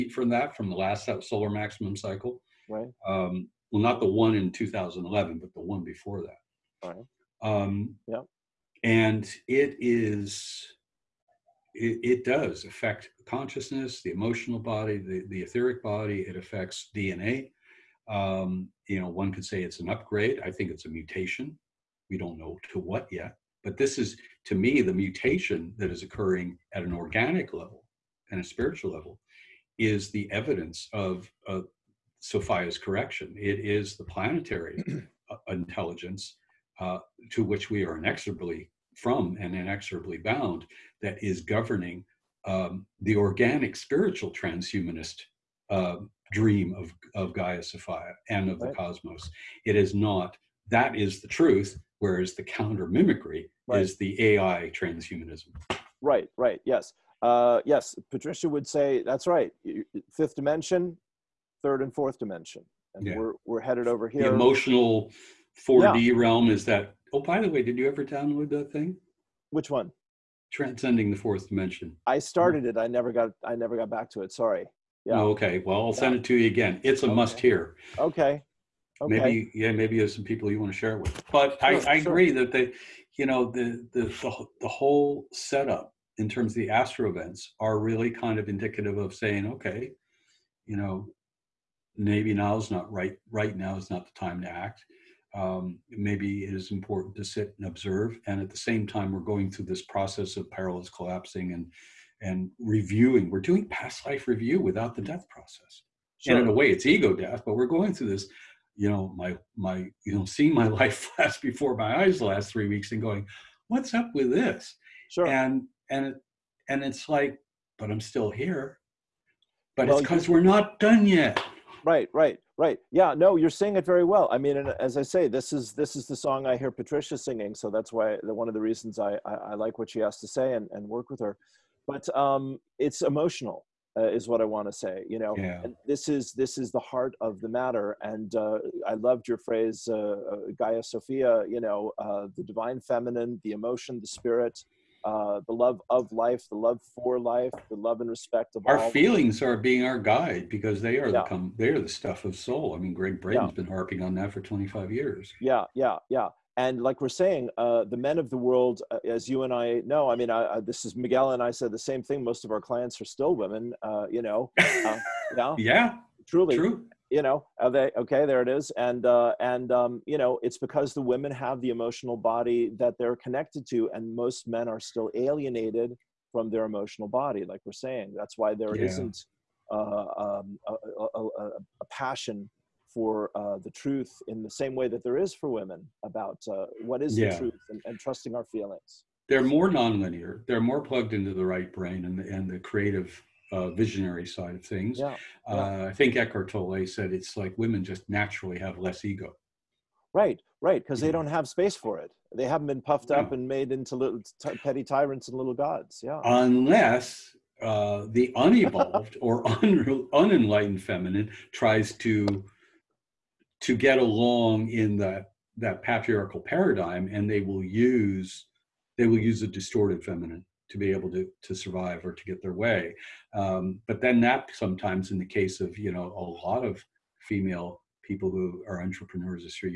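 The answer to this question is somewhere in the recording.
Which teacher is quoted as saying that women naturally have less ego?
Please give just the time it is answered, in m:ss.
3:16.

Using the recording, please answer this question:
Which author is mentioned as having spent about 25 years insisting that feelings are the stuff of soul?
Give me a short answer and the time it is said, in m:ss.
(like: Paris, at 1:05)
Gregg Braden, at 2:32.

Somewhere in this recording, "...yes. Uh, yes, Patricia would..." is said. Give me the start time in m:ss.
0:56.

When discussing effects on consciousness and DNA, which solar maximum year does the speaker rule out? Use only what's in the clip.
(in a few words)
2011.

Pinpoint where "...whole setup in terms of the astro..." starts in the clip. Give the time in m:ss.
1:24.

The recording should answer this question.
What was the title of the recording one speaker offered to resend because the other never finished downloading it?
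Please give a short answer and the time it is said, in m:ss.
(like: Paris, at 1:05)
Transcending the fourth dimension, at 1:10.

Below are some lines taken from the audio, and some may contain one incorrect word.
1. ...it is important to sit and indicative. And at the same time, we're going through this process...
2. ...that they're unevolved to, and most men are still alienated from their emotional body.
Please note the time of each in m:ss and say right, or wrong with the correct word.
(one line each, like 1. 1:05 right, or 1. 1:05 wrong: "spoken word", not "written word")
1. 1:36 wrong: "observe", not "indicative"
2. 2:52 wrong: "connected", not "unevolved".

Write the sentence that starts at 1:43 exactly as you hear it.
We're doing past life review without the mm.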